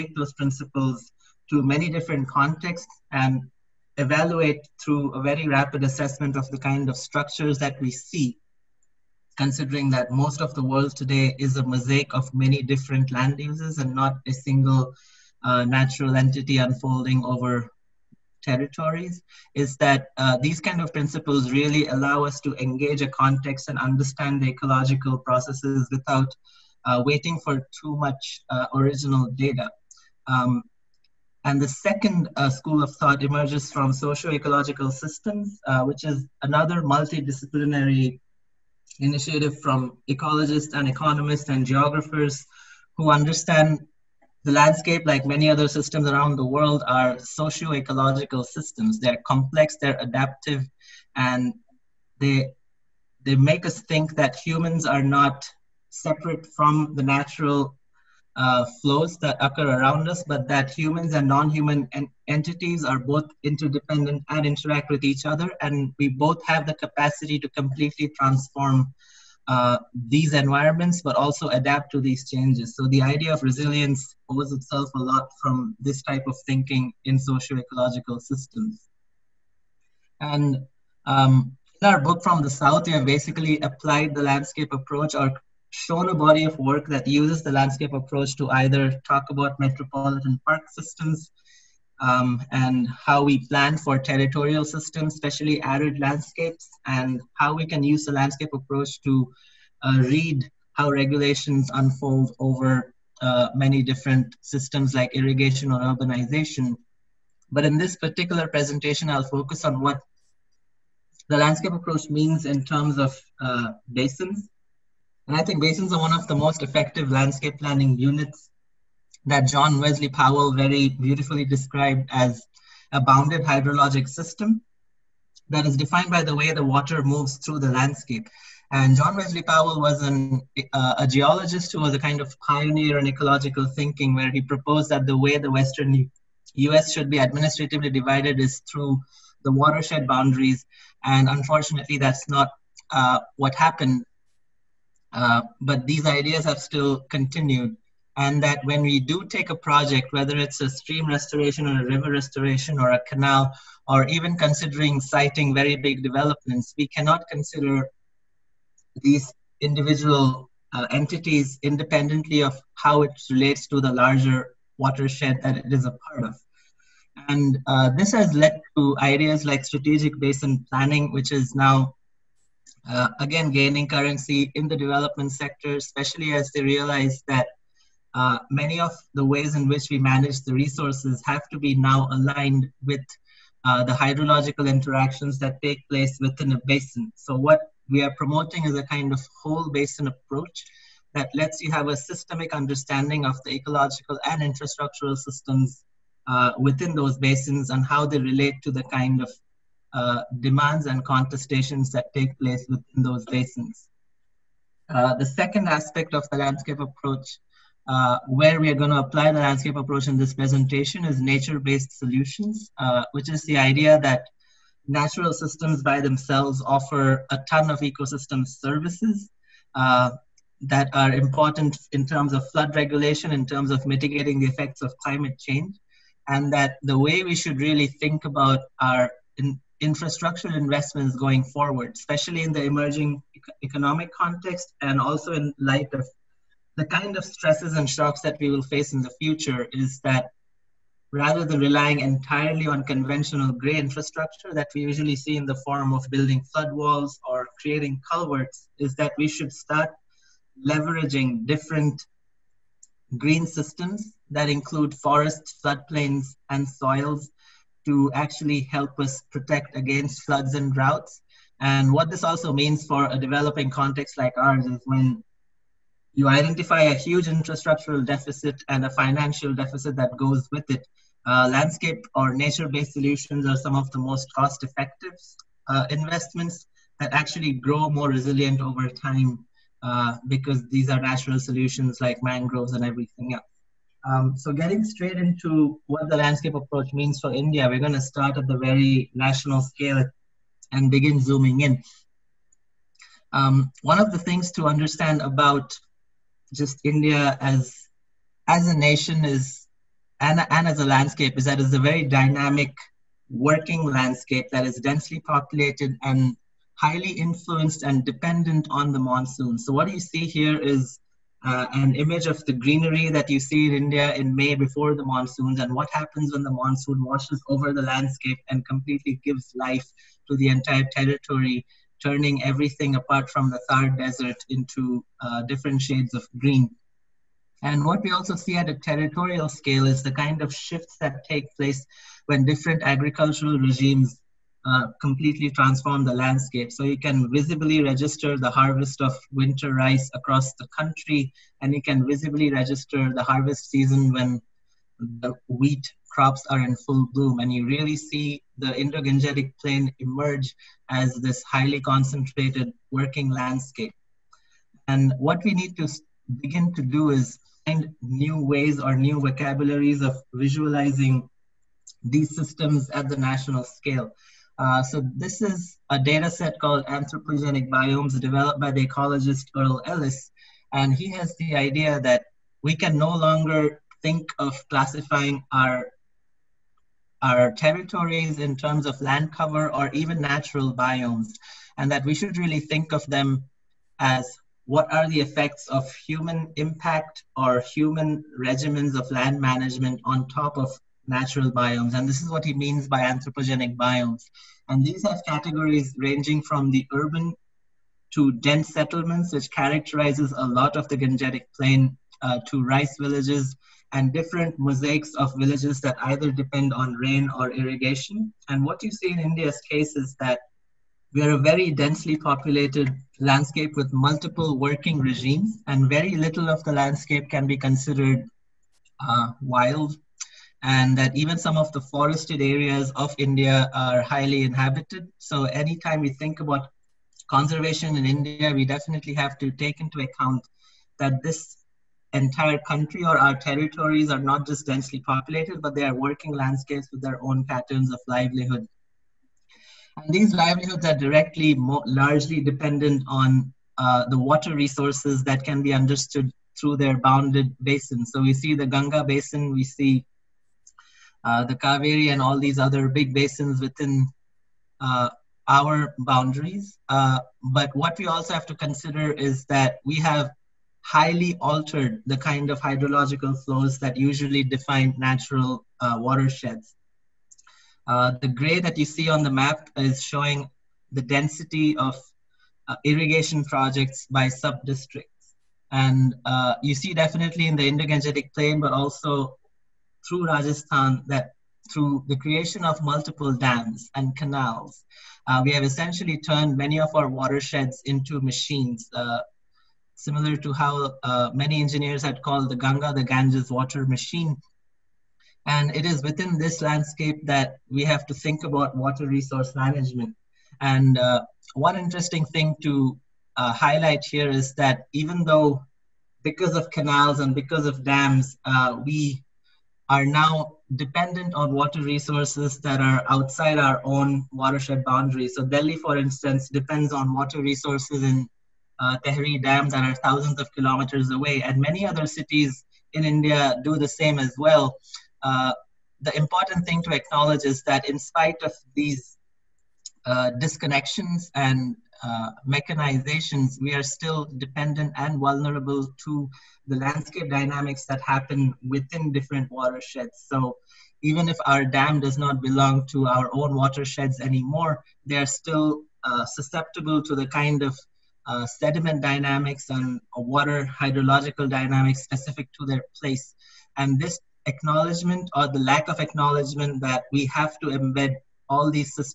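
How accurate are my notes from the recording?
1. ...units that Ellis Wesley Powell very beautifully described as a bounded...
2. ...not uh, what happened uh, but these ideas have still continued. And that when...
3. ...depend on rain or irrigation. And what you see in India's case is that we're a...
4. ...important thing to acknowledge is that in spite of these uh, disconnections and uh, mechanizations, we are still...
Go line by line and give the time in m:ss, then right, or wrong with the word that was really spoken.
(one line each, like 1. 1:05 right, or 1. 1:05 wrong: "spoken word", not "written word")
1. 1:57 wrong: "John", not "Ellis"
2. 2:22 right
3. 6:46 right
4. 8:46 right.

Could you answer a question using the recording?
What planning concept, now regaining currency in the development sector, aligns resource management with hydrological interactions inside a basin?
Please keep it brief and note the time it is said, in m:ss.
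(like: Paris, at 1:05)
Strategic basin planning, at 2:49.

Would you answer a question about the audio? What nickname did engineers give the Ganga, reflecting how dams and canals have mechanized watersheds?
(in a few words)
Ganges water machine.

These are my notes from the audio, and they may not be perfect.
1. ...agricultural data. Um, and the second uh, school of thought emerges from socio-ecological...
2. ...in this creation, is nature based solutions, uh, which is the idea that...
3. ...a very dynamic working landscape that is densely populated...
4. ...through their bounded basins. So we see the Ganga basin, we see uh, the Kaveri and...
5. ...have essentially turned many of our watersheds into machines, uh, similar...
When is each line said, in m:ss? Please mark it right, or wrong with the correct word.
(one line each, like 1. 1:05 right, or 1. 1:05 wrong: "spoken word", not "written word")
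1. 0:28 wrong: "original", not "agricultural"
2. 3:30 wrong: "presentation", not "creation"
3. 5:01 right
4. 7:26 right
5. 8:05 right.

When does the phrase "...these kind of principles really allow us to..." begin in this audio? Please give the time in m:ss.
0:20.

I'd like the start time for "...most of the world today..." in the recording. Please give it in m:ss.
0:10.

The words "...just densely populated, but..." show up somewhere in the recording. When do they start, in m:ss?
7:14.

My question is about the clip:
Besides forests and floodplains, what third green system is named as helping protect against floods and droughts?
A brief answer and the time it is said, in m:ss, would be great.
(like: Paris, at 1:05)
Soils, at 4:16.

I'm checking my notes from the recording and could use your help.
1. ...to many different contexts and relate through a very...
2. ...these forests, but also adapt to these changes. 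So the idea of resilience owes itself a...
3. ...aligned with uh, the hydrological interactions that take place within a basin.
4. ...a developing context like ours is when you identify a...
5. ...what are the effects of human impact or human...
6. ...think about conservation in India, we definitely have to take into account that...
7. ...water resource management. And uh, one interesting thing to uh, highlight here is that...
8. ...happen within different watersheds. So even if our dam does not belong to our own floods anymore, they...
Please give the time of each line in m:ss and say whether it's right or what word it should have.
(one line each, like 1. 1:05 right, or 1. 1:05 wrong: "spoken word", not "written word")
1. 0:01 wrong: "evaluate", not "relate"
2. 1:10 wrong: "environments", not "forests"
3. 3:02 right
4. 4:23 right
5. 6:24 right
6. 7:06 right
7. 8:18 right
8. 8:58 wrong: "watersheds", not "floods".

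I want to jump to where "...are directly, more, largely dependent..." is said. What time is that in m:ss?
7:20.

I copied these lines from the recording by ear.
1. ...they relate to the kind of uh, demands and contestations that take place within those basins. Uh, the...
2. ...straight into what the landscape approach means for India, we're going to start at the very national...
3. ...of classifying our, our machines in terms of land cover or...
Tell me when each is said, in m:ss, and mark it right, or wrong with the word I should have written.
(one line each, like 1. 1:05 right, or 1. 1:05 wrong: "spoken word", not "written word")
1. 3:18 right
2. 4:44 right
3. 6:14 wrong: "territories", not "machines".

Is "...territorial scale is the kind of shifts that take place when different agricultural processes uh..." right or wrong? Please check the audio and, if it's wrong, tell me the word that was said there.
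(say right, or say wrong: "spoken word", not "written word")
wrong: "regimes", not "processes".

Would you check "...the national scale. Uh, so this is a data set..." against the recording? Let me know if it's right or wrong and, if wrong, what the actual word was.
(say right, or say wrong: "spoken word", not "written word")
right.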